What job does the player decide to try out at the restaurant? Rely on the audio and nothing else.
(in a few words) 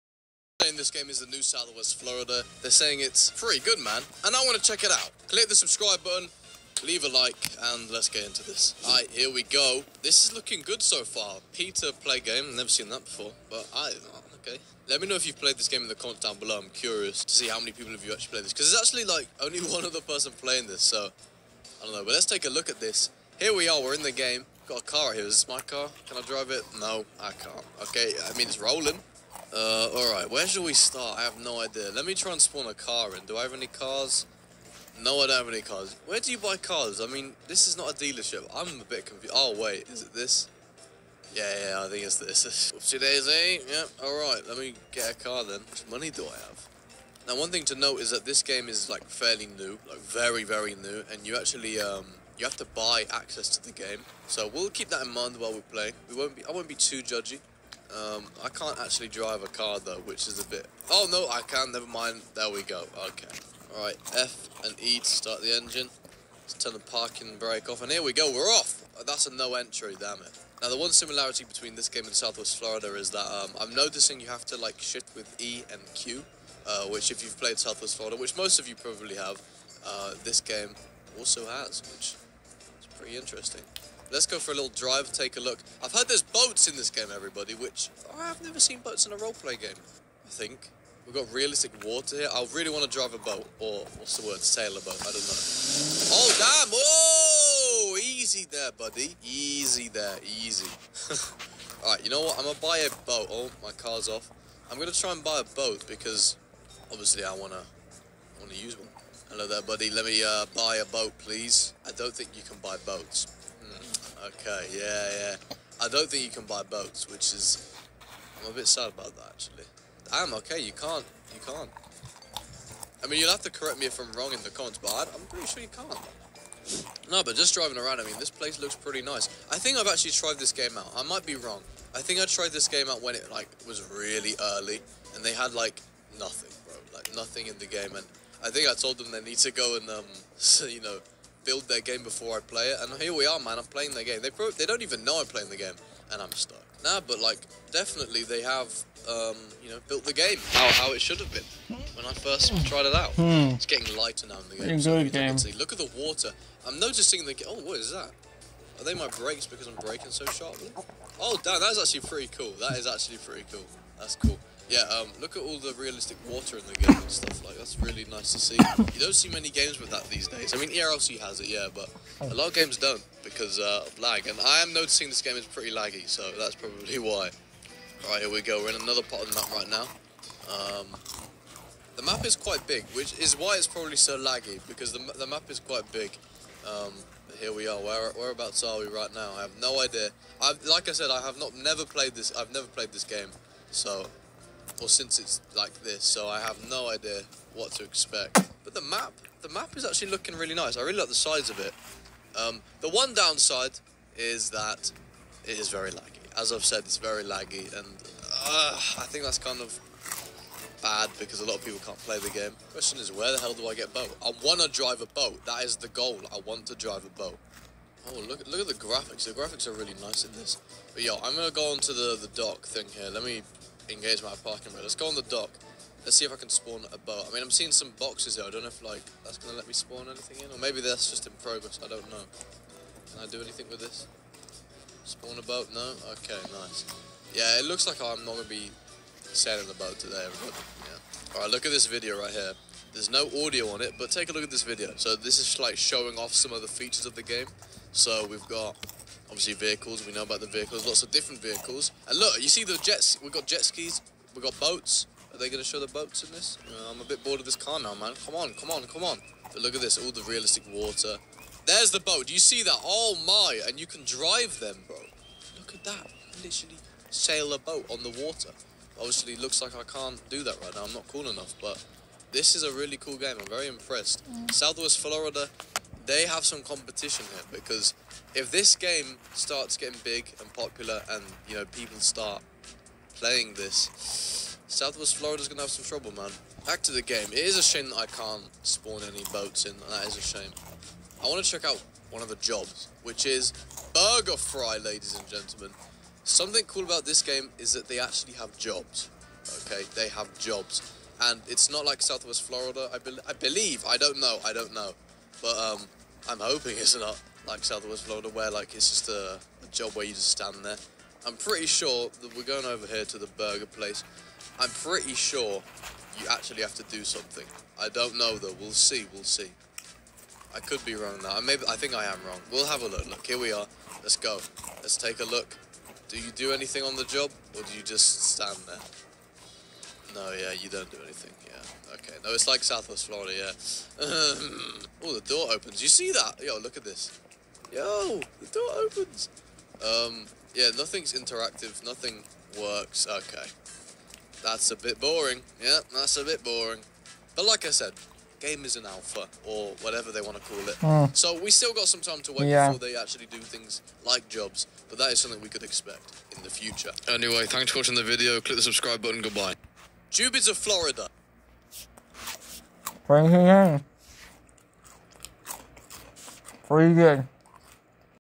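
burger fry.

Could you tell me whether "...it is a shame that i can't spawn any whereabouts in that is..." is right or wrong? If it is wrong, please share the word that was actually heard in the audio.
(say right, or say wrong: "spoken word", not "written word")
wrong: "boats", not "whereabouts".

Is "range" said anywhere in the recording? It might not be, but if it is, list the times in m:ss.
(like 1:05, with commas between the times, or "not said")
not said.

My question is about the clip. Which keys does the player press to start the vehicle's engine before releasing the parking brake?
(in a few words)
F and E.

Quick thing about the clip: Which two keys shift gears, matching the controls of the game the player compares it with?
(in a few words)
E and Q.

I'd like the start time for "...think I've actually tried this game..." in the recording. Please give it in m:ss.
2:09.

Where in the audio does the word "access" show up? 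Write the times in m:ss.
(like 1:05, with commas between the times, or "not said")
0:53.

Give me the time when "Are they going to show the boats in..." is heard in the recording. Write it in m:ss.
4:15.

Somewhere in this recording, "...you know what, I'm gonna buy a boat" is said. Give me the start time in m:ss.
1:42.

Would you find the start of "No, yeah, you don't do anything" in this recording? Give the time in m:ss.
5:30.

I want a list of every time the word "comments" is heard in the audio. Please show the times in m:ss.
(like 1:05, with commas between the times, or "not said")
0:15, 2:04.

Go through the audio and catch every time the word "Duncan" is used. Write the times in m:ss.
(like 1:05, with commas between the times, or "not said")
not said.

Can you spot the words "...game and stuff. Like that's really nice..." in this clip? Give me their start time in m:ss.
2:46.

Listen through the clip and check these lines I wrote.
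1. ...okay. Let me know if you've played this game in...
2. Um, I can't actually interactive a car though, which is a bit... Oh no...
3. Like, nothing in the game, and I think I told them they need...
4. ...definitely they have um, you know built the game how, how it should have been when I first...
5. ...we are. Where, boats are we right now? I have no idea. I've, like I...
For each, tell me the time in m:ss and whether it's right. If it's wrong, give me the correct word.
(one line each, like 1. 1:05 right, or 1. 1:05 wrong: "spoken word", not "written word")
1. 0:14 right
2. 0:57 wrong: "drive", not "interactive"
3. 2:16 right
4. 2:27 right
5. 3:07 wrong: "whereabouts", not "boats".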